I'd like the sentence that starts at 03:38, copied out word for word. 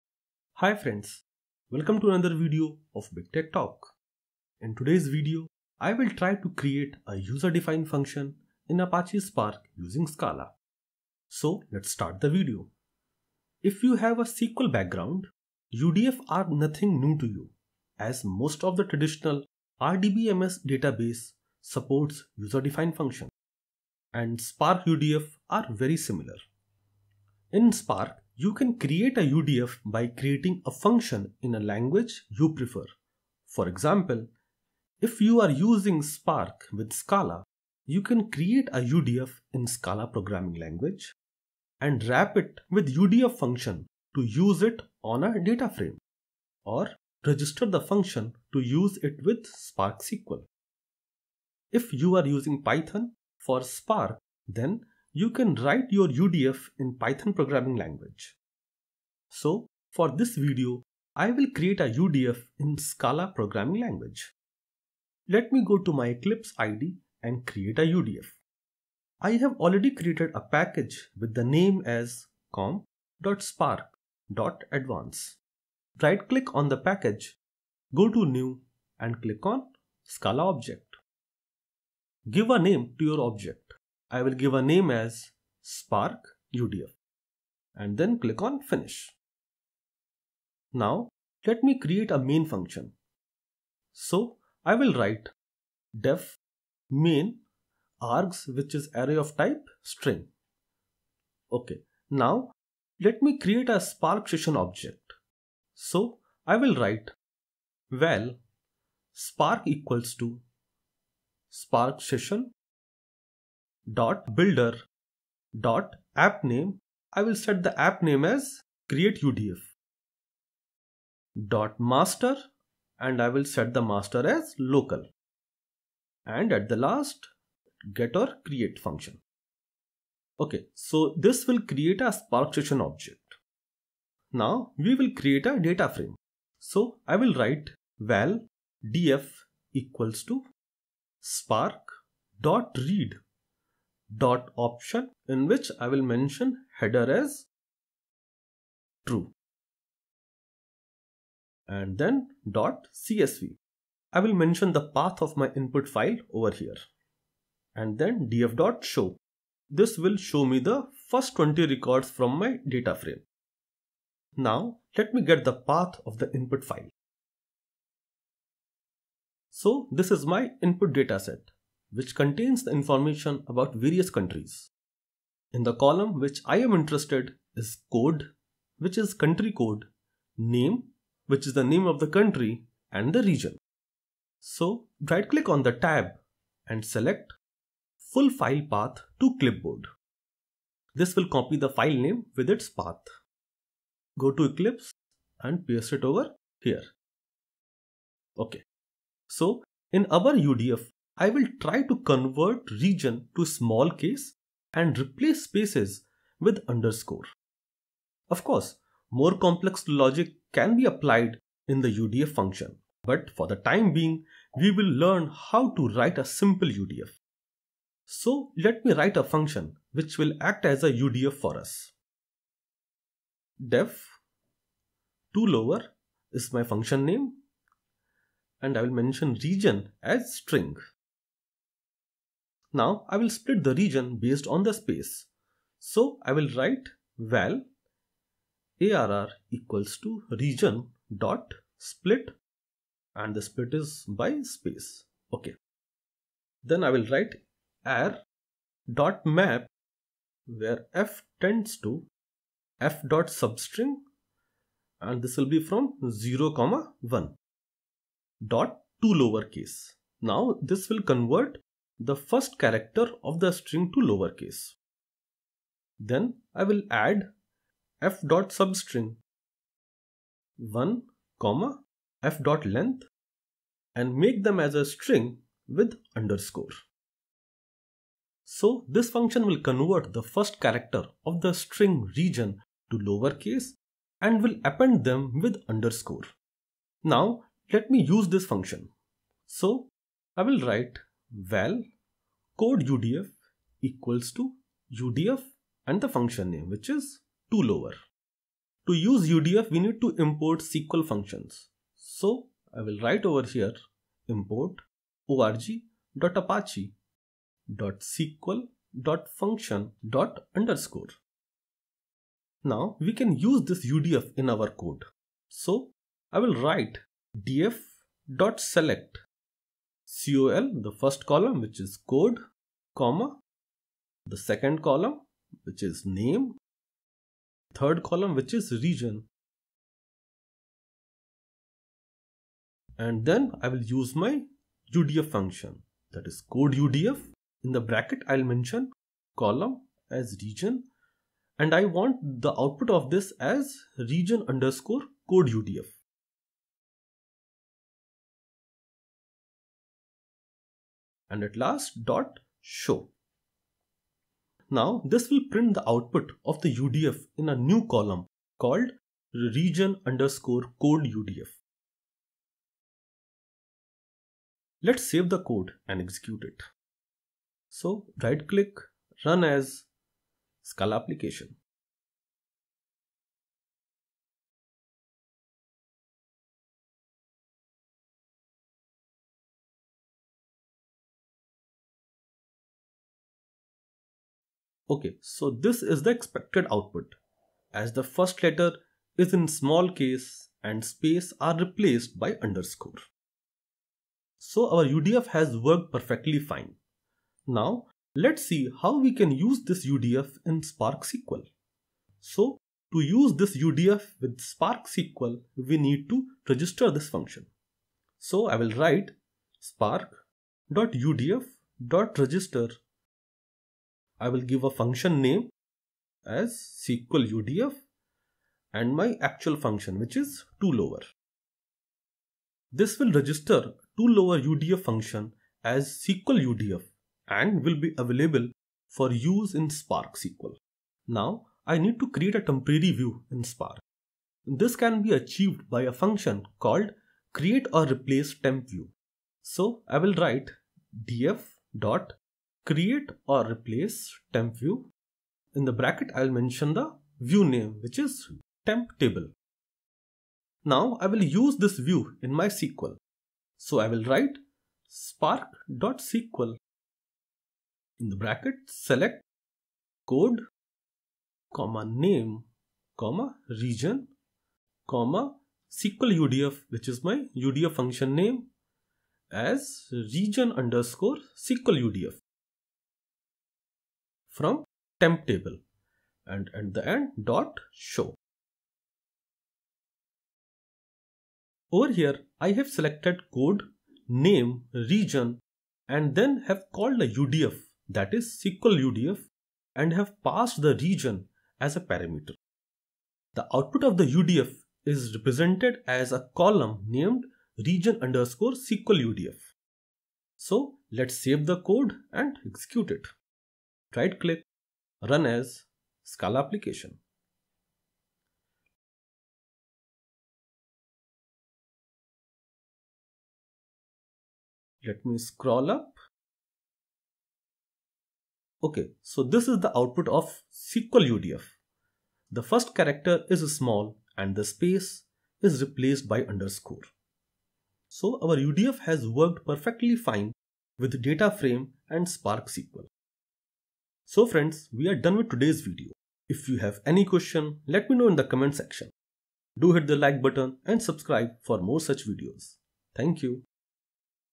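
So let me write a function which will act as a UDF for us.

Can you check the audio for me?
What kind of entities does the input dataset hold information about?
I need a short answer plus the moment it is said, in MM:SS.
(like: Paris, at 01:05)
countries, at 02:54.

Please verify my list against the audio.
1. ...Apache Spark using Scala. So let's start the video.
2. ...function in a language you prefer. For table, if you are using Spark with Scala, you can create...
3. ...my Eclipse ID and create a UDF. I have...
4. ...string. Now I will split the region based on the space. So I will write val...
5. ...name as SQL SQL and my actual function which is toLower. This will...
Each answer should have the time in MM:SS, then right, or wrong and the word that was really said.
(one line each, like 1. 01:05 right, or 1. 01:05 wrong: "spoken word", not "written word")
1. 00:08 right
2. 00:30 wrong: "example", not "table"
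3. 01:05 right
4. 03:50 right
5. 06:55 wrong: "UDF", not "SQL".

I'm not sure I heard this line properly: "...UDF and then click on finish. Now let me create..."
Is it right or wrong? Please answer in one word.
right.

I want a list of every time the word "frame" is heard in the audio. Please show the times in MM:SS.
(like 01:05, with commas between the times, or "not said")
00:45, 02:15, 02:42, 08:51.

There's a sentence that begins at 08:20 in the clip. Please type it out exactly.
So let's save the code and execute it right click, run as Scala application.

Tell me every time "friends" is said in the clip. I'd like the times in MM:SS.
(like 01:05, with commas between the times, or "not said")
00:00, 08:54.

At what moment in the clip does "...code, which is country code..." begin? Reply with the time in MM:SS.
02:57.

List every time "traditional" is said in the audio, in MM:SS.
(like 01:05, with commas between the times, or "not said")
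00:18.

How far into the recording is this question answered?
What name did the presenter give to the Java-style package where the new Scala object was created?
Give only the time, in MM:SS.
01:12.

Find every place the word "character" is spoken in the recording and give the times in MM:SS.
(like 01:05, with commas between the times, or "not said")
04:22, 04:40, 08:42.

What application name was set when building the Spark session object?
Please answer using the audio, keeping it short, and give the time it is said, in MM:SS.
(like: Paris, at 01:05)
create UDF, at 01:58.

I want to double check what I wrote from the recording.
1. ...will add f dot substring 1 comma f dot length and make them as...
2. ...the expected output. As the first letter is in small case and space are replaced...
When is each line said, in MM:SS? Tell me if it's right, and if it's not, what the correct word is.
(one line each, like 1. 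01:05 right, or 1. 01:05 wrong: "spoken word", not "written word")
1. 04:26 right
2. 06:26 right.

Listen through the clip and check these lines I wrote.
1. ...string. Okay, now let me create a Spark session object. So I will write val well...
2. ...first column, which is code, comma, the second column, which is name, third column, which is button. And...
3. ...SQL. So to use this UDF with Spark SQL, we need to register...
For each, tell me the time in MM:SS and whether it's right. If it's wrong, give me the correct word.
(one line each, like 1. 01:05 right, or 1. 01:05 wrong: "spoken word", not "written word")
1. 01:39 right
2. 05:20 wrong: "region", not "button"
3. 06:41 right.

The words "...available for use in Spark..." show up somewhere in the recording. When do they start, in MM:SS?
07:07.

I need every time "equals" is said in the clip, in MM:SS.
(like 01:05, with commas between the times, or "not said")
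01:49, 02:19, 03:59, 04:53.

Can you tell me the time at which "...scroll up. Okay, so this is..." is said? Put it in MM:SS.
08:35.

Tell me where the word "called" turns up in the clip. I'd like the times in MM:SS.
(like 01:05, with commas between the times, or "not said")
05:58, 07:16, 08:06.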